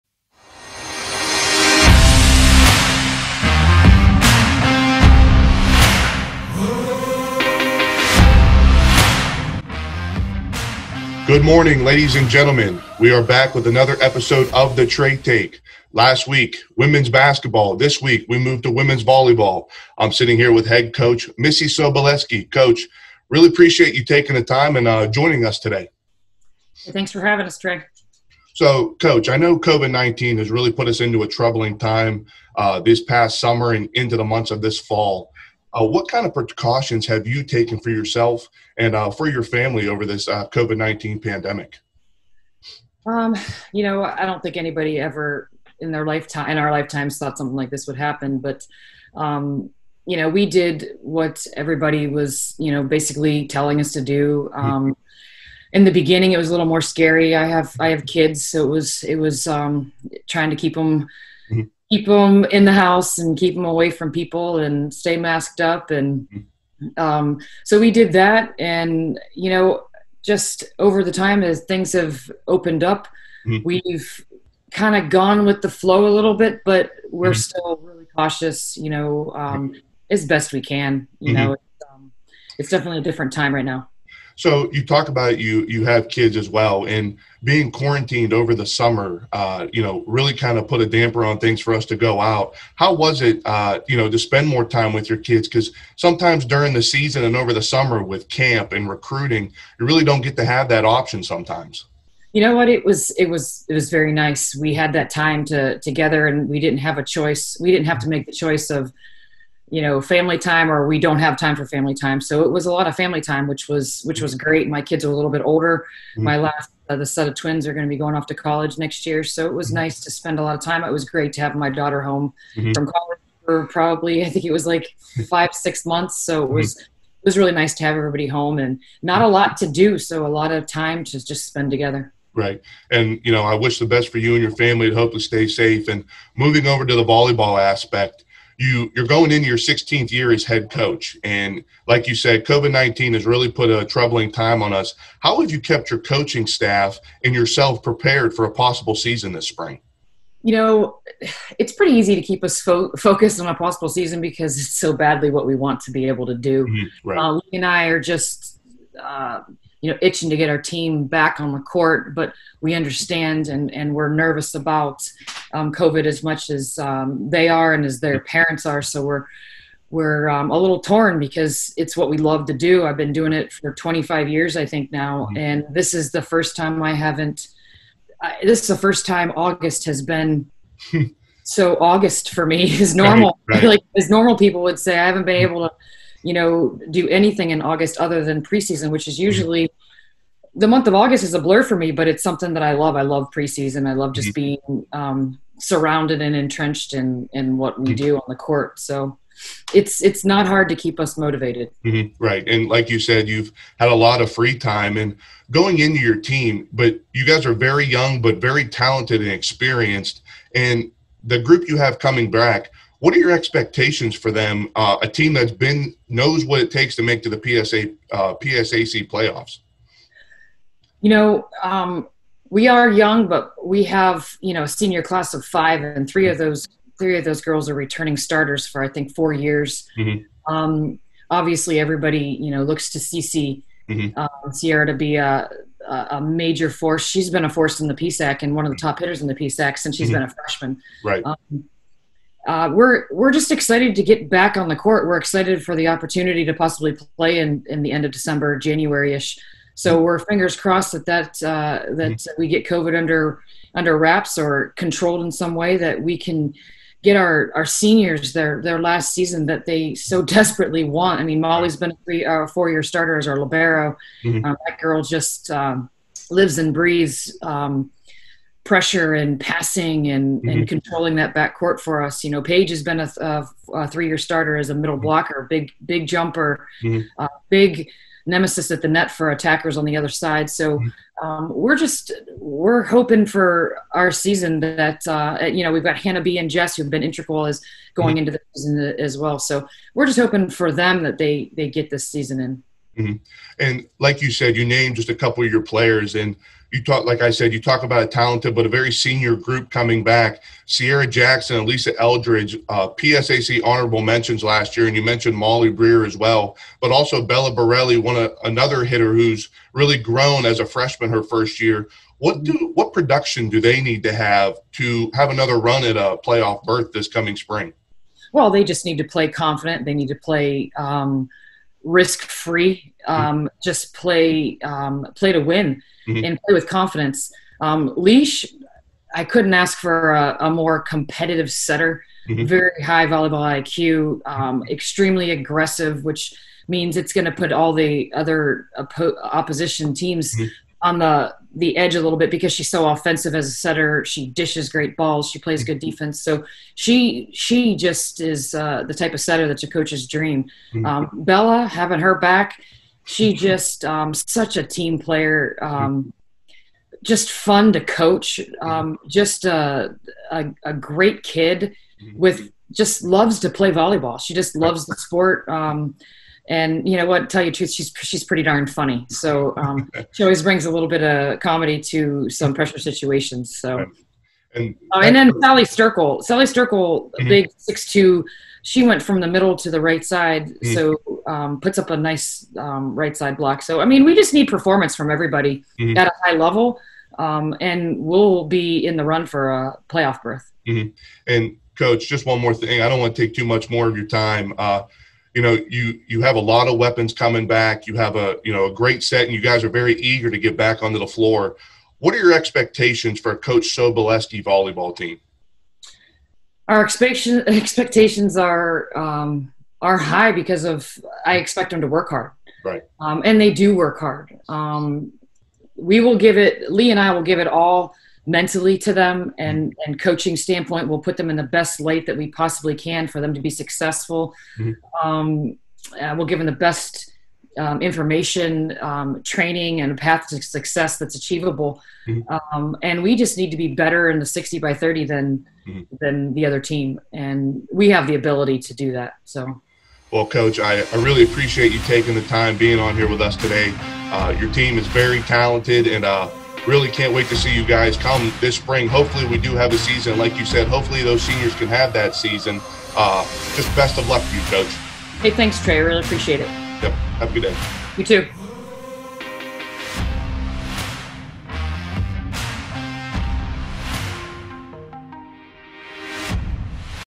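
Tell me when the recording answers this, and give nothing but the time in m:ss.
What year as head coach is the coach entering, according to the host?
2:19.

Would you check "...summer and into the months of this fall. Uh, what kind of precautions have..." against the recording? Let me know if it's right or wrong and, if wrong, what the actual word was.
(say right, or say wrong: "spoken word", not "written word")
right.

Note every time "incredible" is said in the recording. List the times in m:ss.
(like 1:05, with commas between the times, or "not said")
not said.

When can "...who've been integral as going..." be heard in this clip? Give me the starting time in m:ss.
4:46.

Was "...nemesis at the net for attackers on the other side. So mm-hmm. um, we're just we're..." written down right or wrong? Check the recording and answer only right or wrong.
right.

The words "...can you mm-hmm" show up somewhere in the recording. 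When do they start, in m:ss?
1:20.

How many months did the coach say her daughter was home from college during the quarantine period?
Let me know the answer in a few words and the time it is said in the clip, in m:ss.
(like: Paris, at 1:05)
5 or 6, at 2:05.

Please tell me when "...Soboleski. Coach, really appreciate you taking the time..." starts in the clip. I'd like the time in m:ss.
0:21.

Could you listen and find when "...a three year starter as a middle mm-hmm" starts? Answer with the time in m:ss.
4:33.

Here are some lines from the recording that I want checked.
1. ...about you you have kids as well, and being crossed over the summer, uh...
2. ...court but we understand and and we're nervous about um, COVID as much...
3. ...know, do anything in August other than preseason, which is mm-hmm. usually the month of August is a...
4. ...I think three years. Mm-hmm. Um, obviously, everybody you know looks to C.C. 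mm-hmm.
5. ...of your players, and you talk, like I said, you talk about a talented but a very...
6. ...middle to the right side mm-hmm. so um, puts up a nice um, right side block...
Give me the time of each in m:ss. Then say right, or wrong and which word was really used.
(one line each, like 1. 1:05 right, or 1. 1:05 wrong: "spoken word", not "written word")
1. 1:25 wrong: "quarantined", not "crossed"
2. 2:41 right
3. 3:06 right
4. 3:48 wrong: "four", not "three"
5. 4:55 right
6. 6:19 right.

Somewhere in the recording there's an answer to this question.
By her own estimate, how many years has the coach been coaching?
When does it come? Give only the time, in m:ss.
2:53.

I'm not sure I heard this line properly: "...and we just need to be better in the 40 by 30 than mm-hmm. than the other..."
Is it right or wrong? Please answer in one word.
wrong.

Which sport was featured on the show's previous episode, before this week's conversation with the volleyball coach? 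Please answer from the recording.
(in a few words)
Women's basketball.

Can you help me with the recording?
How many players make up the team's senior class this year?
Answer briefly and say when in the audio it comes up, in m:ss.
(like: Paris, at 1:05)
5, at 3:44.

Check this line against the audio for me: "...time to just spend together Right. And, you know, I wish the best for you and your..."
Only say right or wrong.
right.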